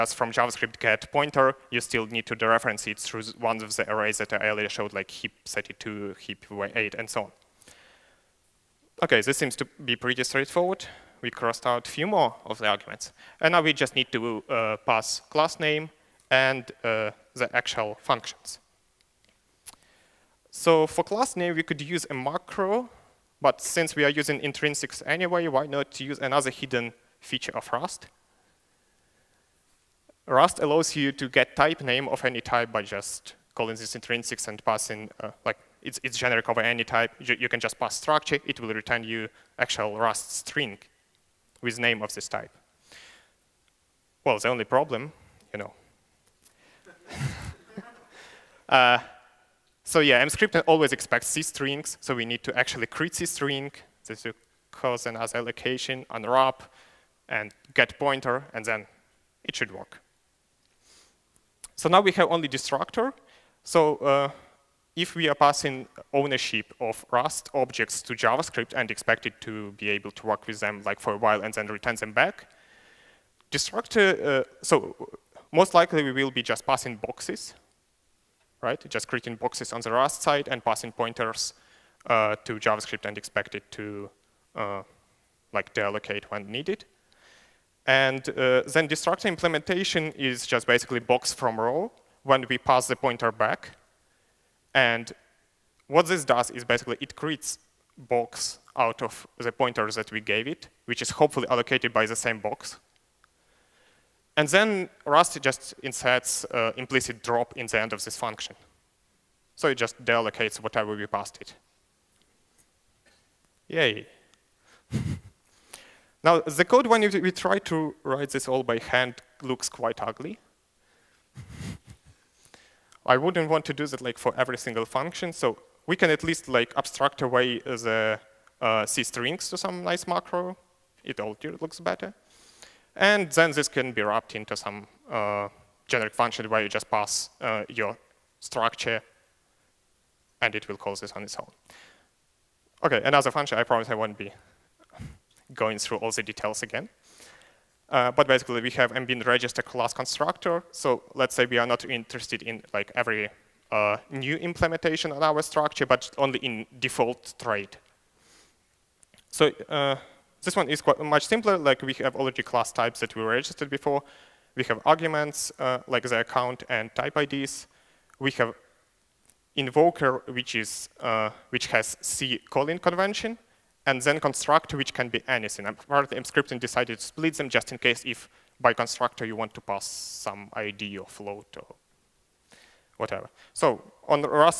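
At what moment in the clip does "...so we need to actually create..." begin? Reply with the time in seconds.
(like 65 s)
51 s.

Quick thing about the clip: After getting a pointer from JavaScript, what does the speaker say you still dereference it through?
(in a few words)
arrays.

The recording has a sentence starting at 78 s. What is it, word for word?
Just creating boxes on the Rust side and passing pointers uh, to JavaScript and expect it to uh, like deallocate when needed.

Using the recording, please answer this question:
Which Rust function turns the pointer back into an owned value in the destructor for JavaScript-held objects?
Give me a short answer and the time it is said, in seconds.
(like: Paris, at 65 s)
box from raw, at 90 s.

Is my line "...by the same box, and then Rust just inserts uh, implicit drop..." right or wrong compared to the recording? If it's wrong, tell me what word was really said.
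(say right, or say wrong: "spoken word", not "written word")
right.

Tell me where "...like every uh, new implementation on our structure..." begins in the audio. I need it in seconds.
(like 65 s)
152 s.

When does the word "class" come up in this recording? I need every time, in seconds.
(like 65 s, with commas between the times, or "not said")
15 s, 21 s, 149 s, 162 s.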